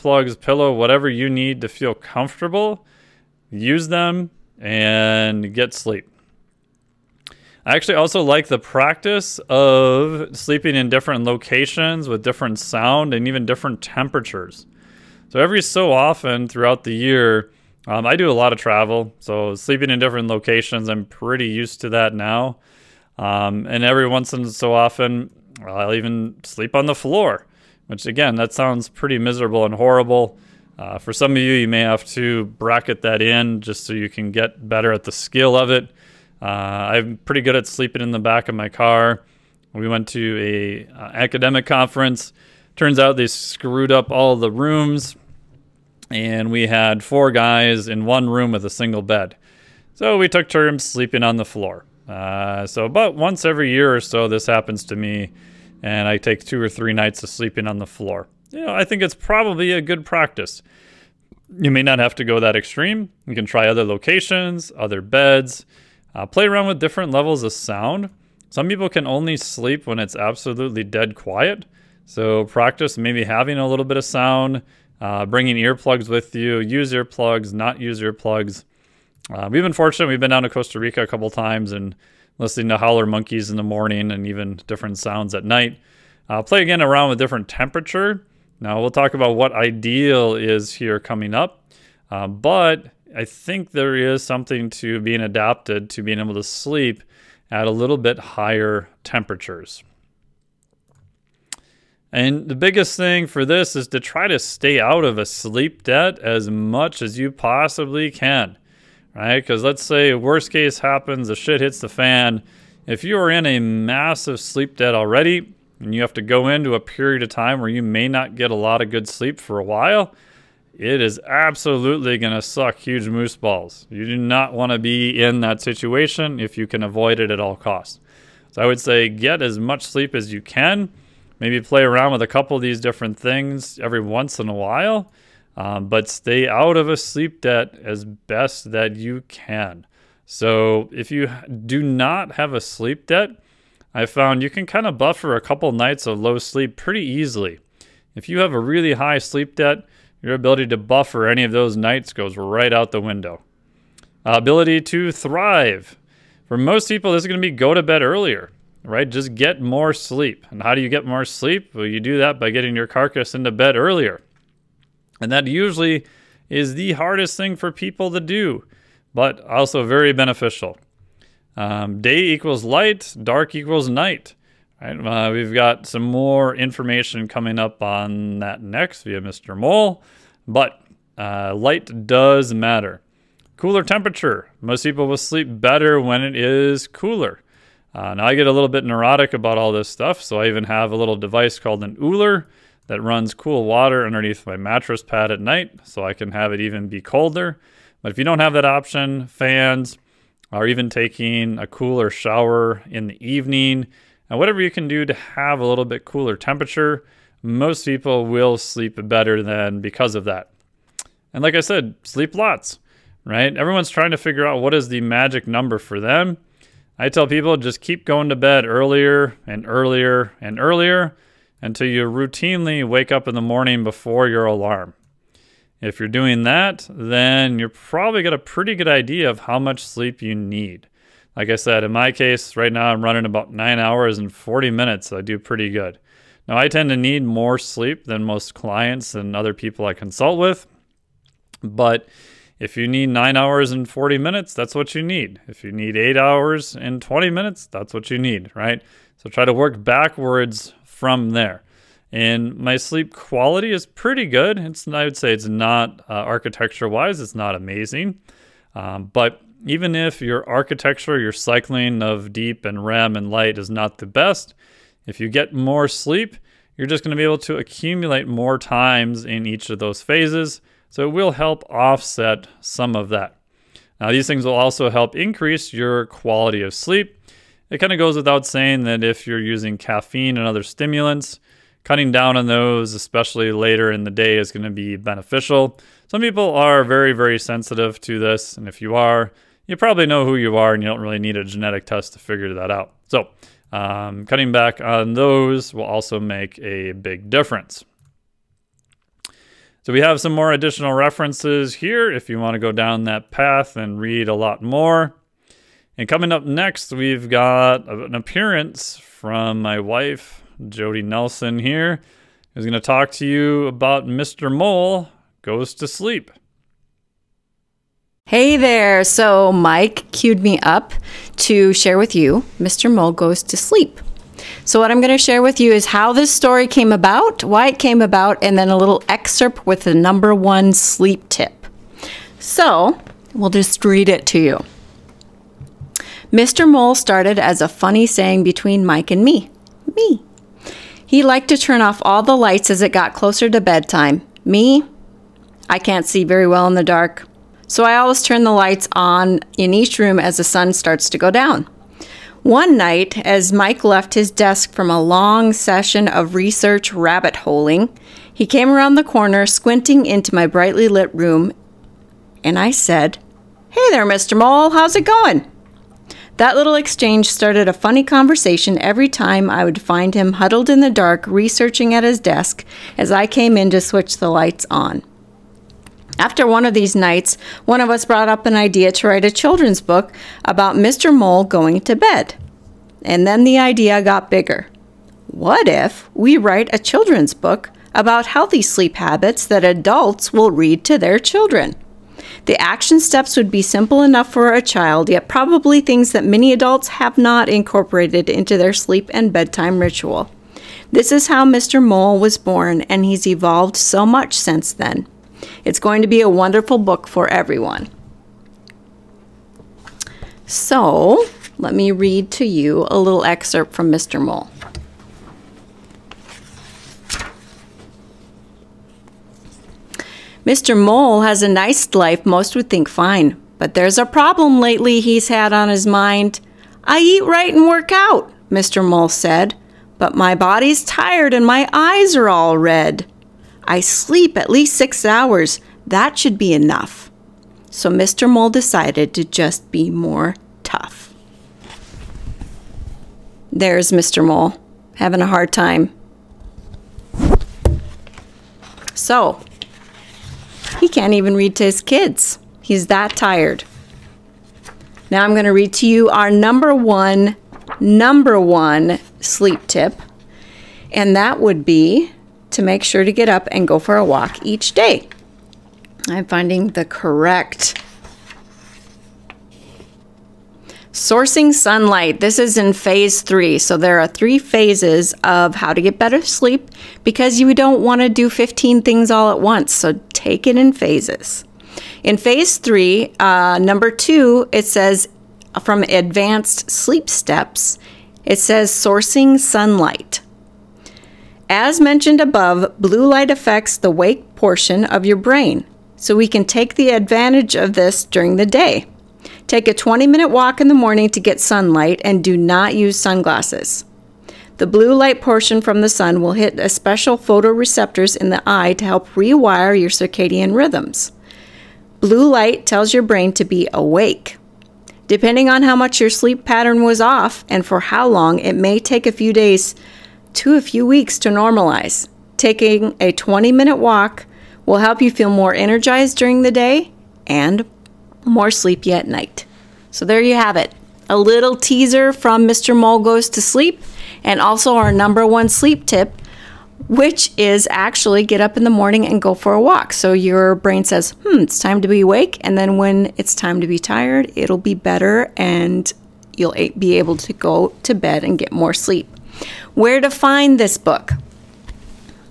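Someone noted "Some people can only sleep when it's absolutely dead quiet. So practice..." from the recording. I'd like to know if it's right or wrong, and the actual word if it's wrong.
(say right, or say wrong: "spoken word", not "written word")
right.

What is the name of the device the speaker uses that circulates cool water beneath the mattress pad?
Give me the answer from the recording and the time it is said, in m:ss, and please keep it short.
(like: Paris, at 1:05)
Ooler, at 3:12.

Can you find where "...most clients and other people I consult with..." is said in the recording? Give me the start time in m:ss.
3:58.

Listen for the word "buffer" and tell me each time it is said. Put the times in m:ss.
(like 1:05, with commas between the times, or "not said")
2:24, 2:30.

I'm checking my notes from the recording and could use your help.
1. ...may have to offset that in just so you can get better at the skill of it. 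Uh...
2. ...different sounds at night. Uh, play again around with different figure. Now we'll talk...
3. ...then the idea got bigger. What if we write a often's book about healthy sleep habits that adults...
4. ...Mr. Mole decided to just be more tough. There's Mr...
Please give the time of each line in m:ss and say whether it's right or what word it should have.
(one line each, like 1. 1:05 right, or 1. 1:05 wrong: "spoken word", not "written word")
1. 0:31 wrong: "bracket", not "offset"
2. 1:24 wrong: "temperature", not "figure"
3. 6:23 wrong: "children", not "often"
4. 7:17 right.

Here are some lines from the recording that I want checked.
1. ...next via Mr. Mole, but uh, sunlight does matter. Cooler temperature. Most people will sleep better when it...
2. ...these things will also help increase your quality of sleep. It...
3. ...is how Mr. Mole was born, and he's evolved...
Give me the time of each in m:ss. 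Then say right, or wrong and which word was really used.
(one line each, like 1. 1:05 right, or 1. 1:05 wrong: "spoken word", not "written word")
1. 2:58 wrong: "light", not "sunlight"
2. 4:34 right
3. 6:41 right.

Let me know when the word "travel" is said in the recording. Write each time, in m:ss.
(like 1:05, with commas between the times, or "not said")
0:18.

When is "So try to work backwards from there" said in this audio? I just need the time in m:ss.
4:09.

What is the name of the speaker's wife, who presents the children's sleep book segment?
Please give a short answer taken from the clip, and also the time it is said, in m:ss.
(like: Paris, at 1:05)
Jodie Nelson, at 5:10.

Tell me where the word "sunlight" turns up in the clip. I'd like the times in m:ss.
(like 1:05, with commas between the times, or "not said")
7:51, 8:09, 8:21.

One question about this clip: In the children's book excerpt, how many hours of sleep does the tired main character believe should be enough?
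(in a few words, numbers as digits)
6 hours.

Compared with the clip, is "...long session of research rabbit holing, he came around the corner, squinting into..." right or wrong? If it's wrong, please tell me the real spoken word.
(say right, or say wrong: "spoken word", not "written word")
right.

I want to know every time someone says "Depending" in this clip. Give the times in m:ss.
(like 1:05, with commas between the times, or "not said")
8:35.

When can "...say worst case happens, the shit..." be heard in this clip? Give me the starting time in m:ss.
1:49.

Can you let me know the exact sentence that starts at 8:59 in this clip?
So your brain says, hmm, it's time to be awake.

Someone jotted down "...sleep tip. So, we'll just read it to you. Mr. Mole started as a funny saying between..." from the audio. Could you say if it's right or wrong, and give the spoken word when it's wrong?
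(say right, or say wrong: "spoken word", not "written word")
right.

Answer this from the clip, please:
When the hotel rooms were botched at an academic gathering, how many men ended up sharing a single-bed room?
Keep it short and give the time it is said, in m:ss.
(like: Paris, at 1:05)
4, at 0:47.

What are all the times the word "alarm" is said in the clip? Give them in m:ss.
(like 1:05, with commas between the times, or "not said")
3:44.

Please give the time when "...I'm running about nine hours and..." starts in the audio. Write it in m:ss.
3:52.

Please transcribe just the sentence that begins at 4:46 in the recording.
Some people are very, very sensitive to this.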